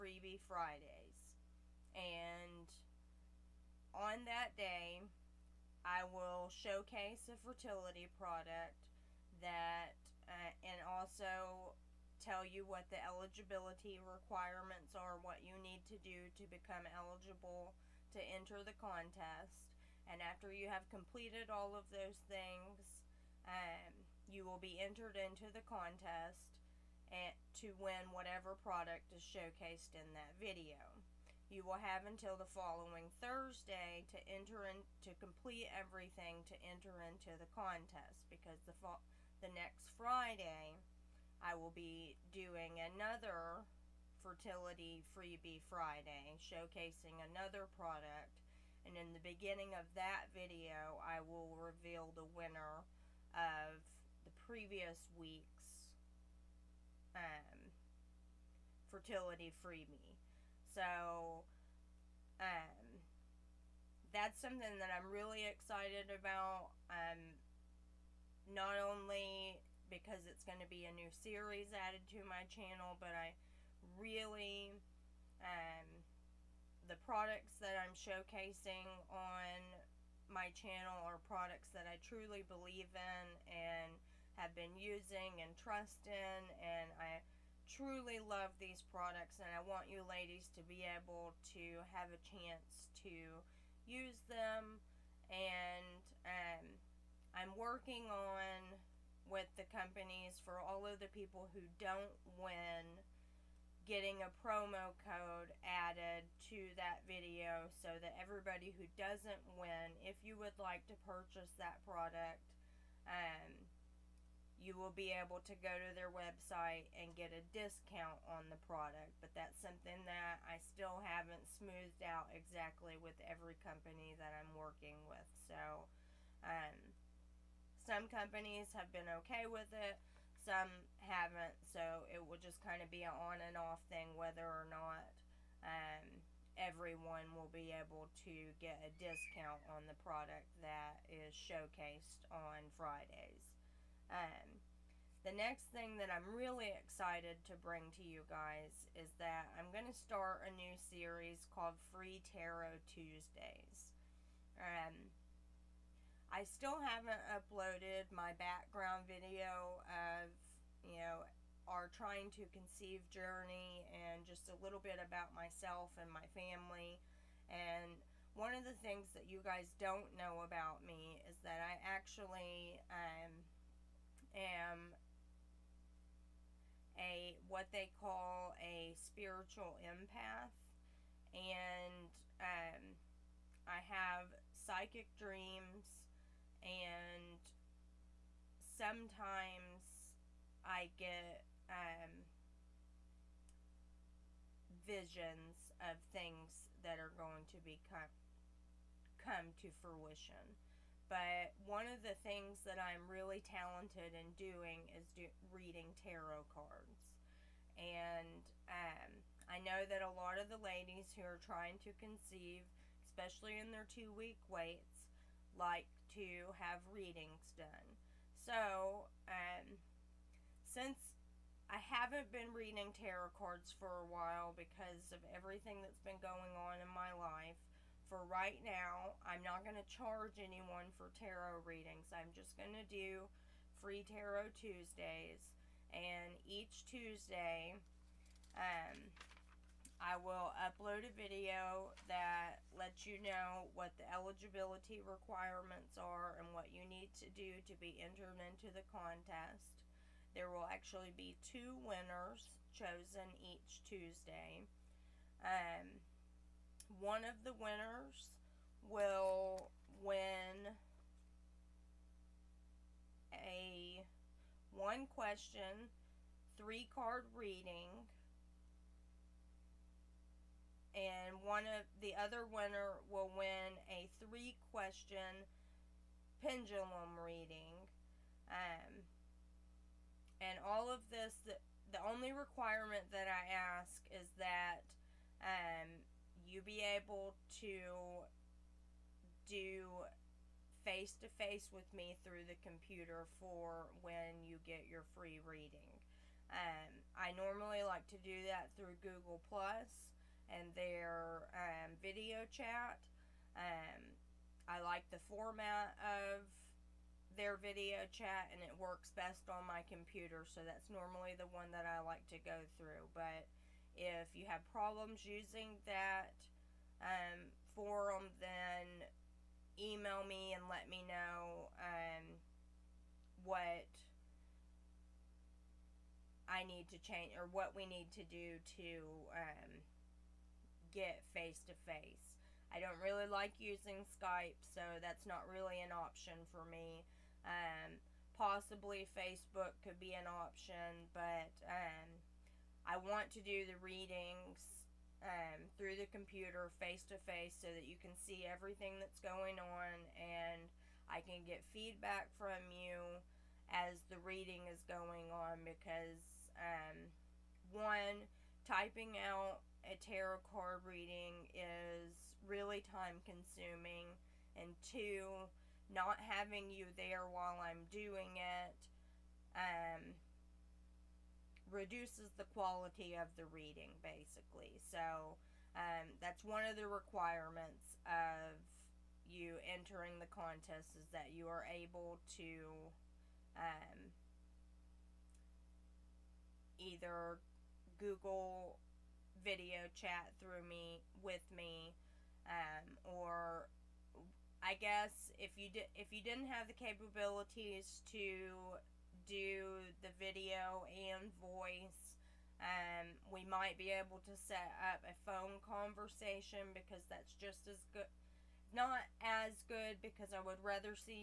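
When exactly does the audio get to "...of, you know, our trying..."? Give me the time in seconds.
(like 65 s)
159 s.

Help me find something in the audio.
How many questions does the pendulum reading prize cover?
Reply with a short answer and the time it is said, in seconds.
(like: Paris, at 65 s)
3, at 274 s.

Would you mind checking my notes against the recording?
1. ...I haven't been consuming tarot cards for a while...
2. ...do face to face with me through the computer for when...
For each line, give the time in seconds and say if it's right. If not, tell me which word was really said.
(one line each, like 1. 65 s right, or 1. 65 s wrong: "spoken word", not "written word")
1. 221 s wrong: "reading", not "consuming"
2. 289 s right.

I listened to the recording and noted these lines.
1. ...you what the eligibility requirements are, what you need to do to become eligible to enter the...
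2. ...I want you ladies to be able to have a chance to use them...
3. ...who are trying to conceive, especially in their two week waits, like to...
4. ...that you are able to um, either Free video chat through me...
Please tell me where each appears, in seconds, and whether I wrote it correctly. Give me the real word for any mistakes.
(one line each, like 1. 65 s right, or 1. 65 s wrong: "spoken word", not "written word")
1. 12 s right
2. 89 s right
3. 211 s right
4. 381 s wrong: "Google", not "Free".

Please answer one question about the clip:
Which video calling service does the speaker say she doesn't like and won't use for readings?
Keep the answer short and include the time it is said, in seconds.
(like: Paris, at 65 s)
Skype, at 334 s.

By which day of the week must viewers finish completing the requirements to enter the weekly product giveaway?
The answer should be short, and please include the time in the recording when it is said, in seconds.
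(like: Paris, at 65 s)
Thursday, at 33 s.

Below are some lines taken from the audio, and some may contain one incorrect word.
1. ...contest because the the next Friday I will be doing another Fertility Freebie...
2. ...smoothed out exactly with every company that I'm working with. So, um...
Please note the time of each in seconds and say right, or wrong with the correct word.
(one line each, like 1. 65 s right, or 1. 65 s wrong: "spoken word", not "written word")
1. 37 s right
2. 121 s right.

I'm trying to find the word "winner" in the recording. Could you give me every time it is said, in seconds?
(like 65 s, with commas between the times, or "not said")
52 s, 251 s, 257 s, 272 s.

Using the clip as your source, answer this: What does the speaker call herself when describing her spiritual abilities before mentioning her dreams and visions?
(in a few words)
spiritual empath.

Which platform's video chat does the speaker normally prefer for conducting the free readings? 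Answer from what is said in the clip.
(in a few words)
Google Plus.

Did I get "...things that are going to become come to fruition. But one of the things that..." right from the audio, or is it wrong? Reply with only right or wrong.
right.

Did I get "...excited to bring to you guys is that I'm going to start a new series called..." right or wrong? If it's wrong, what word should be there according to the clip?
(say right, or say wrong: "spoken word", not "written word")
right.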